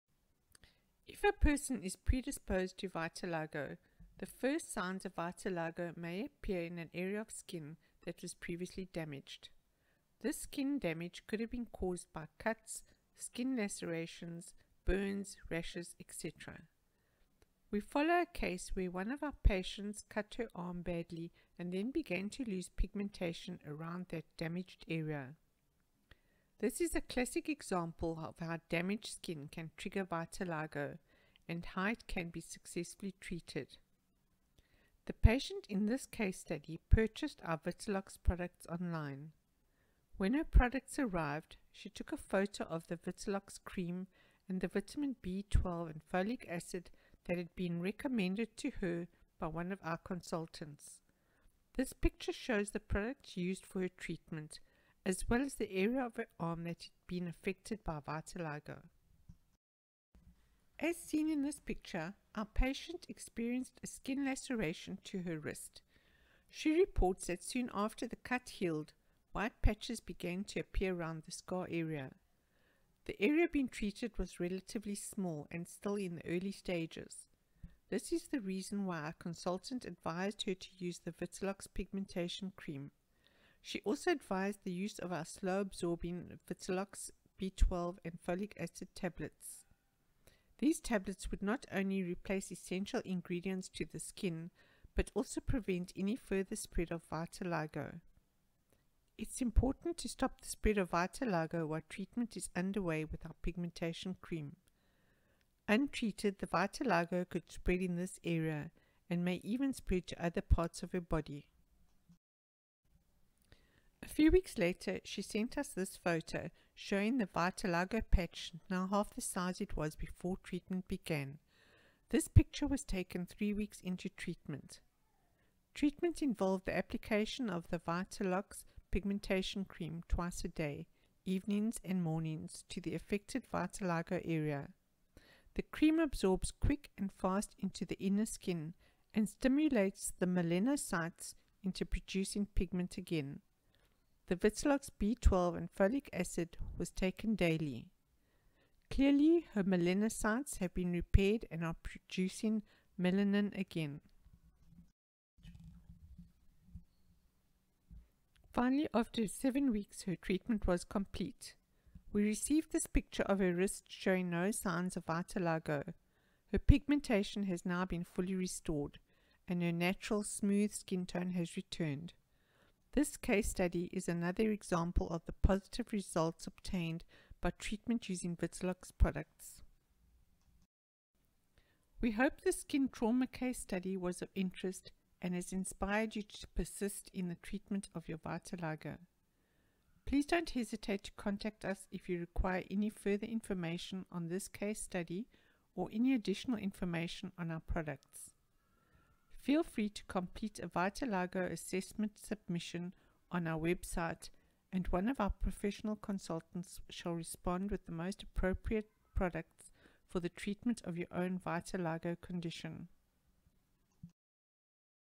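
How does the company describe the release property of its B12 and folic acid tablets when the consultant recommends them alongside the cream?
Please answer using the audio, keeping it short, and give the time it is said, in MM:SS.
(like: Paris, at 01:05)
Slow absorbing, at 01:25.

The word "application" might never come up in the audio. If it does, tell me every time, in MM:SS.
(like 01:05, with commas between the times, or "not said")
02:06.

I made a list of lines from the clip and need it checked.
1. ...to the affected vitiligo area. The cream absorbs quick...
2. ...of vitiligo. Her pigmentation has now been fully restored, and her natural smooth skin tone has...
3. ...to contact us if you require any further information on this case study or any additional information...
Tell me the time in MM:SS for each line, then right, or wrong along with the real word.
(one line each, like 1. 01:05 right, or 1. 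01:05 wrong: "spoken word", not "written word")
1. 02:12 right
2. 02:44 right
3. 03:11 right.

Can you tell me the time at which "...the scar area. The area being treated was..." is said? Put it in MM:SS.
01:11.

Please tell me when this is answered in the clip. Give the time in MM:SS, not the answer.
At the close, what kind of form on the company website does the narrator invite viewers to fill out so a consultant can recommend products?
03:20.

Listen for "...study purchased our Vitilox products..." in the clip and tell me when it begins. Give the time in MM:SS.
00:36.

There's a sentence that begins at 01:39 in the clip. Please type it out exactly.
It's important to stop the spread of vitiligo while treatment is underway with our pigmentation cream.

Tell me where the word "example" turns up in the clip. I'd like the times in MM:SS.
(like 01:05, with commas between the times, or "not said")
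00:27, 02:54.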